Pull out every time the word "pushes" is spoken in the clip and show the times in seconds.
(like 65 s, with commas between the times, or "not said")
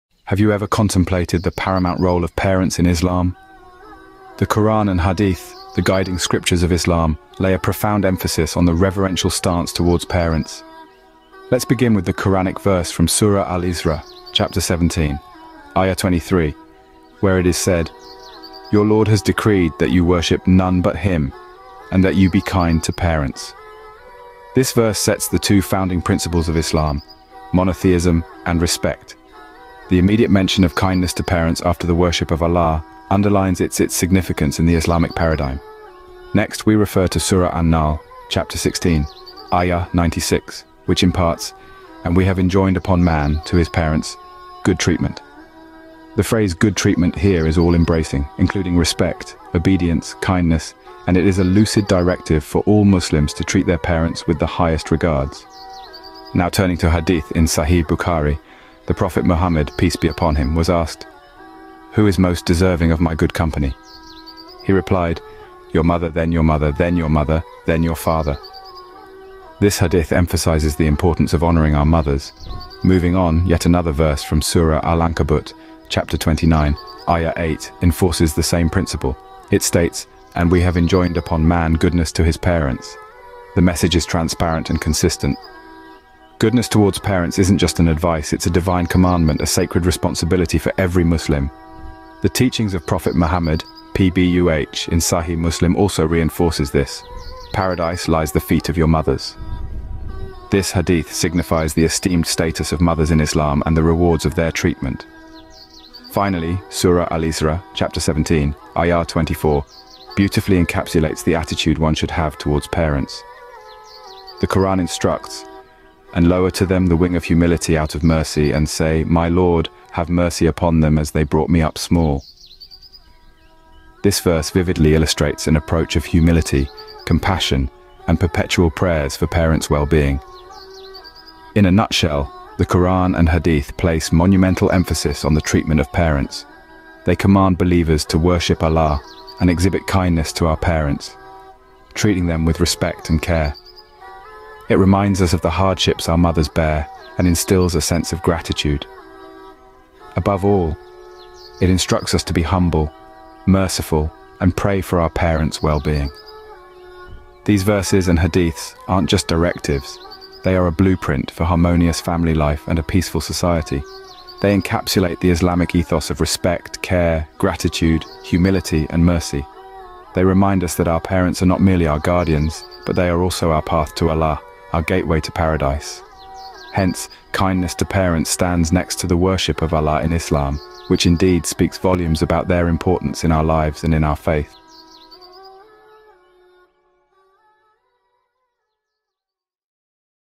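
not said.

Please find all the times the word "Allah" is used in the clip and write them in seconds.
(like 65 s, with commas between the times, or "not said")
32 s, 138 s, 174 s, 179 s.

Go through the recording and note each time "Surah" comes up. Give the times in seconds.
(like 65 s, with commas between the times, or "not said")
13 s, 37 s, 74 s, 106 s.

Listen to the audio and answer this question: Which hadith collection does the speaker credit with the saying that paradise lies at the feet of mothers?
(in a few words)
Sahih Muslim.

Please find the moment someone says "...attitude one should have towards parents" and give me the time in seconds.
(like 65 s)
111 s.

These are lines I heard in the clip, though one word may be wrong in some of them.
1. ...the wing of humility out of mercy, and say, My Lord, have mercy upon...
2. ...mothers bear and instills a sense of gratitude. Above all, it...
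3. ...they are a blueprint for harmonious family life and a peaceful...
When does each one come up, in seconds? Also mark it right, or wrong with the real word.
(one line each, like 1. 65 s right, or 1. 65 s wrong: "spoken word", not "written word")
1. 116 s right
2. 146 s right
3. 160 s right.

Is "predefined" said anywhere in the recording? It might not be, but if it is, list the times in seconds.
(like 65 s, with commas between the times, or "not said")
not said.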